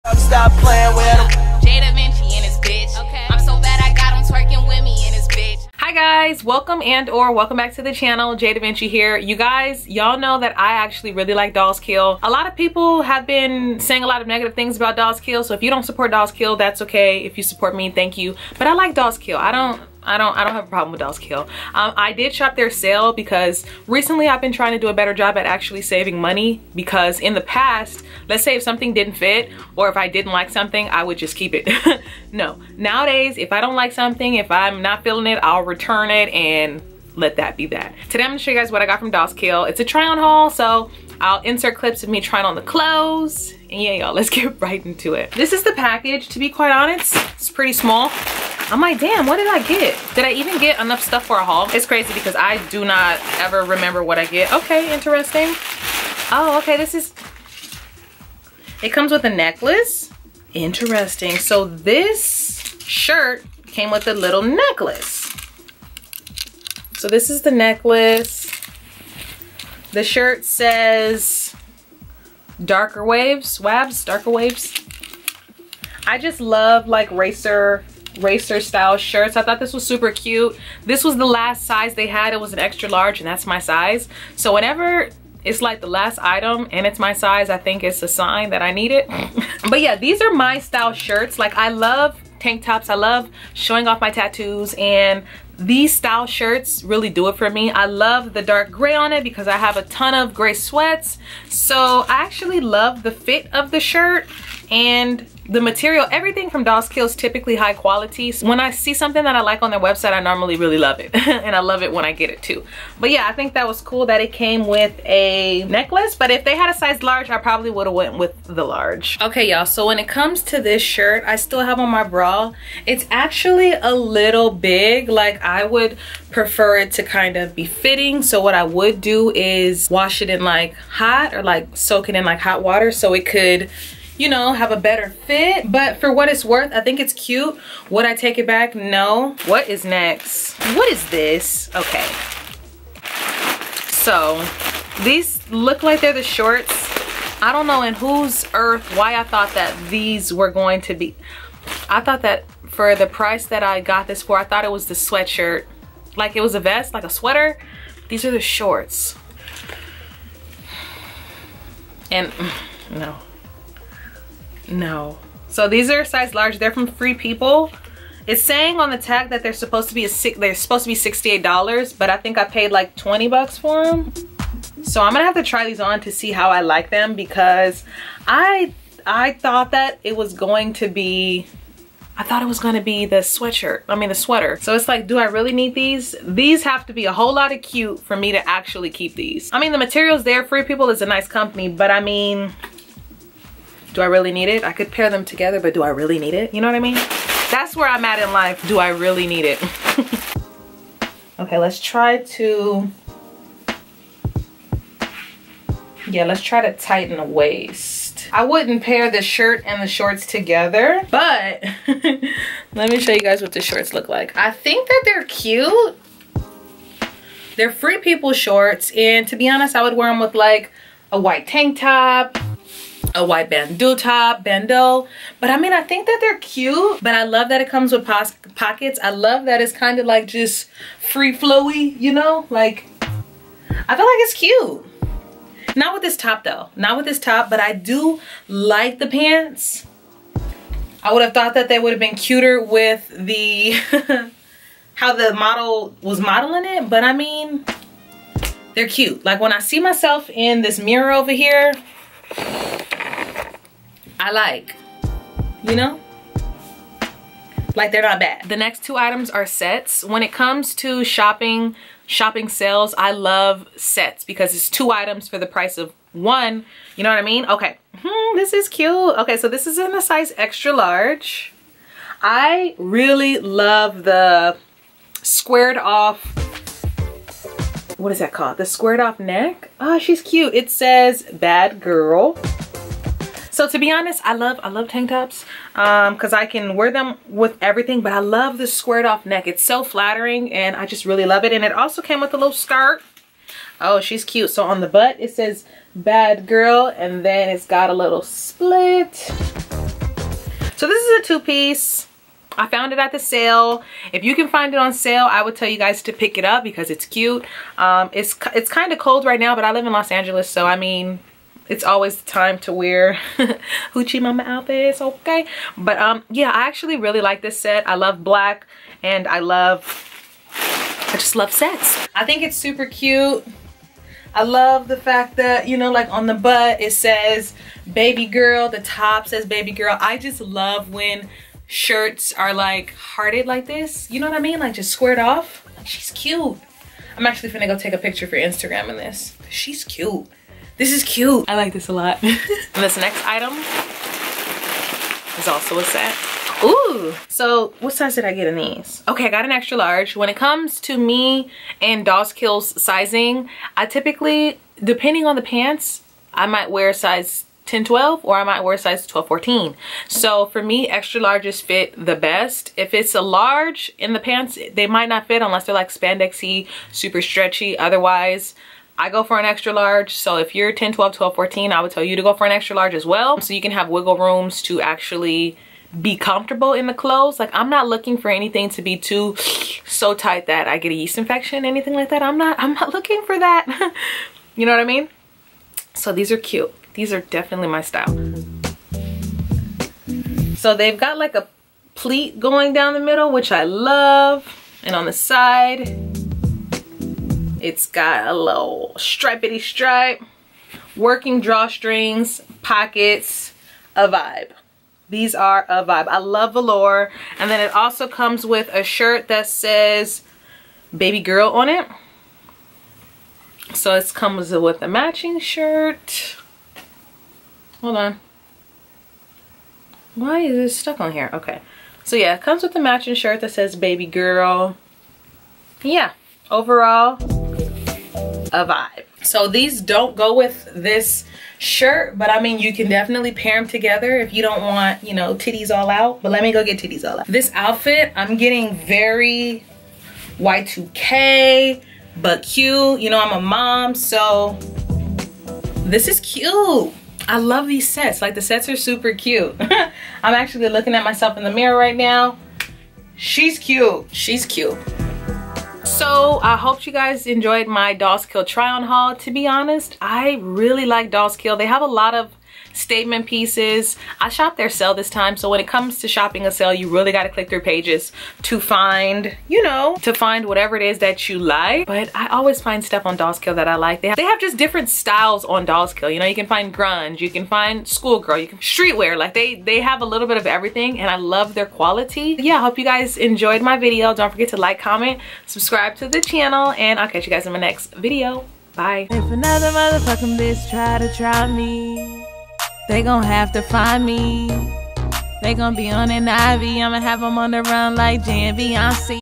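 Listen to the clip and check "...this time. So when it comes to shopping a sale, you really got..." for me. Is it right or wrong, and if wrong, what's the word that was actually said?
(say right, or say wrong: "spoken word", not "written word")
right.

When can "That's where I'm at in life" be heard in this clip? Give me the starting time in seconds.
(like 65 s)
197 s.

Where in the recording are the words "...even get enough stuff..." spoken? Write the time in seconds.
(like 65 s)
50 s.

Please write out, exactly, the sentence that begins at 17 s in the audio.
If you support me, thank you.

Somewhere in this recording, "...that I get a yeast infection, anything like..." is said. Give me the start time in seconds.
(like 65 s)
380 s.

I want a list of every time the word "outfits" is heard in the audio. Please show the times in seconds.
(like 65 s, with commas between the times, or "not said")
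314 s, 437 s.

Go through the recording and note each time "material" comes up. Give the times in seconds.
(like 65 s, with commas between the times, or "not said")
105 s, 189 s.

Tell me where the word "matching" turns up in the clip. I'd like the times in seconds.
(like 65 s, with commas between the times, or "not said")
414 s, 422 s.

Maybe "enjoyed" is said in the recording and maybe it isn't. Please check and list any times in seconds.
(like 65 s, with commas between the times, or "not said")
457 s, 483 s.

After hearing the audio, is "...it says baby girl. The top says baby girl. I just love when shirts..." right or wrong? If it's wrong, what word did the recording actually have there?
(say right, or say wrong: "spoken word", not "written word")
right.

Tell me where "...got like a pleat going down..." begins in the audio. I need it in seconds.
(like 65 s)
390 s.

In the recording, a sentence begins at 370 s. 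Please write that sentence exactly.
So if you're 10, 12, 12, 14, I would tell you to go for an extra large as well.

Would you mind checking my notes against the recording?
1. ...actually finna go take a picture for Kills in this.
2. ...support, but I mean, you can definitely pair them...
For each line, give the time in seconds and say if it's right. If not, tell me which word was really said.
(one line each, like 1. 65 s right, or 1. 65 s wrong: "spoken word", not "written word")
1. 337 s wrong: "Instagram", not "Kills"
2. 431 s wrong: "shirt", not "support".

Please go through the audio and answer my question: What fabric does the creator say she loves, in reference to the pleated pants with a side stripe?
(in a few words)
Velour.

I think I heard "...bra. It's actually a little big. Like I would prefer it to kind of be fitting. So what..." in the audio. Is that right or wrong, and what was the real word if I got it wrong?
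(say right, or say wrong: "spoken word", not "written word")
right.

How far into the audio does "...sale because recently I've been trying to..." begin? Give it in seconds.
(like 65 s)
22 s.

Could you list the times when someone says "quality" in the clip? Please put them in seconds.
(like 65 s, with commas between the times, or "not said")
107 s, 481 s.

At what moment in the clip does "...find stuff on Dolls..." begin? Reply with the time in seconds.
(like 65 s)
472 s.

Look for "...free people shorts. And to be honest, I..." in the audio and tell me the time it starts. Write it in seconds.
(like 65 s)
217 s.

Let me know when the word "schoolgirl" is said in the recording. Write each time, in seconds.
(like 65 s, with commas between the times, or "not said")
477 s.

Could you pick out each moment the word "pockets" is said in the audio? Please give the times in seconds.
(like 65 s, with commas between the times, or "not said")
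228 s, 402 s.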